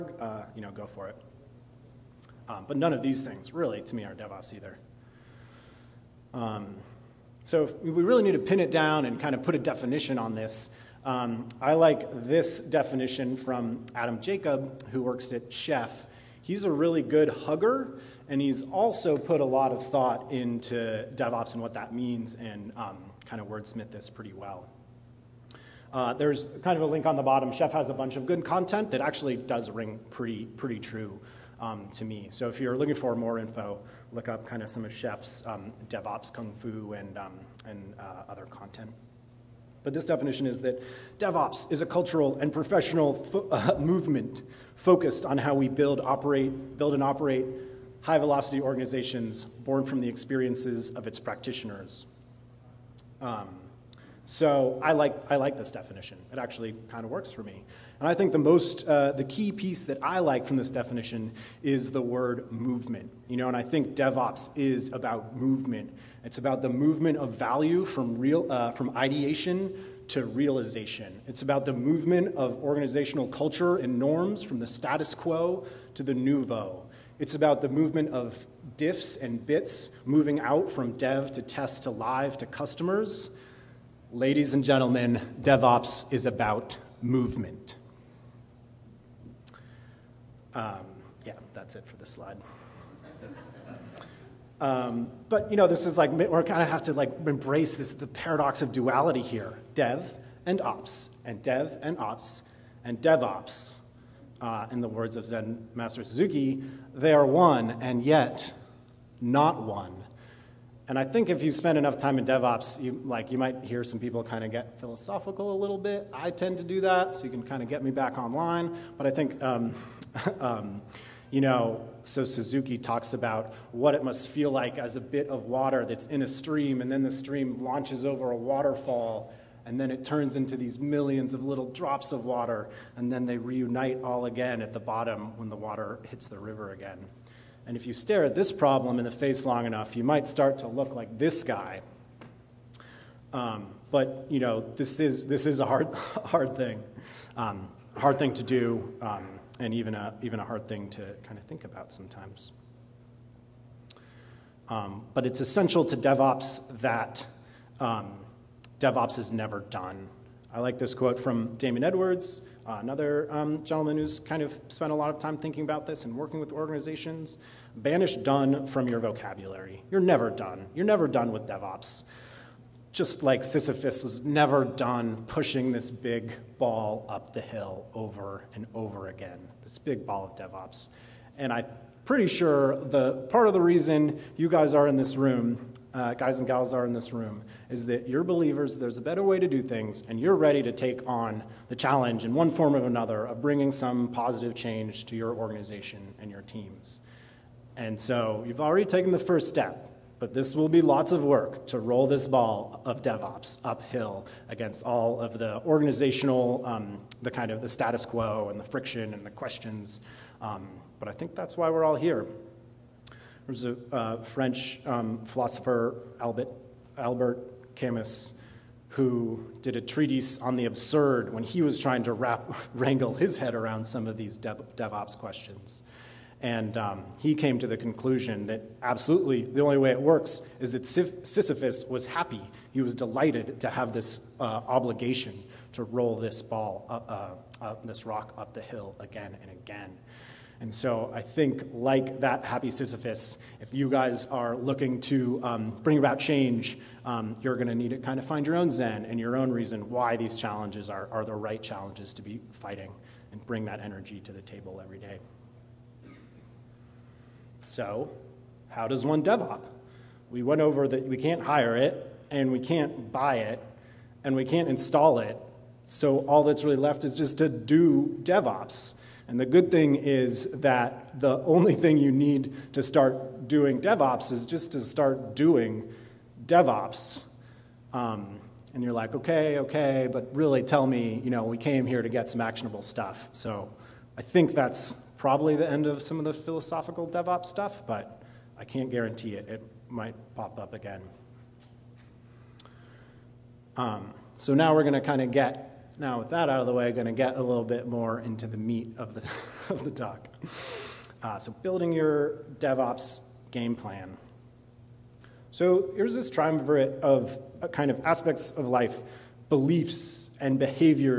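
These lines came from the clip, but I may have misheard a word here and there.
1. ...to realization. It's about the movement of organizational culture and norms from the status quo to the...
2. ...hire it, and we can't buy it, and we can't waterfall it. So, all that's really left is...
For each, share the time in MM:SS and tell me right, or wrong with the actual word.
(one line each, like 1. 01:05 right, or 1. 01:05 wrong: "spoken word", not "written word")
1. 01:10 right
2. 04:21 wrong: "install", not "waterfall".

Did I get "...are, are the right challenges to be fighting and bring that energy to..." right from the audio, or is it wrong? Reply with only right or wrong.
right.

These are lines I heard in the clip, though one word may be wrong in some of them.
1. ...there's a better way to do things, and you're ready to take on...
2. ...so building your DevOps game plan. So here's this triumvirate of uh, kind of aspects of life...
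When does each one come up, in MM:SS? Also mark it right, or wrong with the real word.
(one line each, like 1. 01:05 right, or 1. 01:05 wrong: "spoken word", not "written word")
1. 03:08 right
2. 05:01 right.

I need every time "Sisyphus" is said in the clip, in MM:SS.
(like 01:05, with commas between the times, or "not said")
02:53, 03:50, 04:02.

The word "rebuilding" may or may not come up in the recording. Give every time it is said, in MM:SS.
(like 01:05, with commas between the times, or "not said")
not said.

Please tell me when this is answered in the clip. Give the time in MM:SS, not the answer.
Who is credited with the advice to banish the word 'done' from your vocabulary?
02:41.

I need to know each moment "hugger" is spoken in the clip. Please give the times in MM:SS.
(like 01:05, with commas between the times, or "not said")
00:17.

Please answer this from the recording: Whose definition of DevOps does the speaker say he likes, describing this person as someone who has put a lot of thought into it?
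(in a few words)
Adam Jacob.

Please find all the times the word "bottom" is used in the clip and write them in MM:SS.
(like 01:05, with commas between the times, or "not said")
00:27, 02:14.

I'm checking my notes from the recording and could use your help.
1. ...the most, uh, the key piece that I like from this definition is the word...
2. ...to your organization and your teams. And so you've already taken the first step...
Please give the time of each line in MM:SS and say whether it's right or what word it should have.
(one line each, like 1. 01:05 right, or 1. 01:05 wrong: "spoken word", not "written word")
1. 00:58 right
2. 03:15 right.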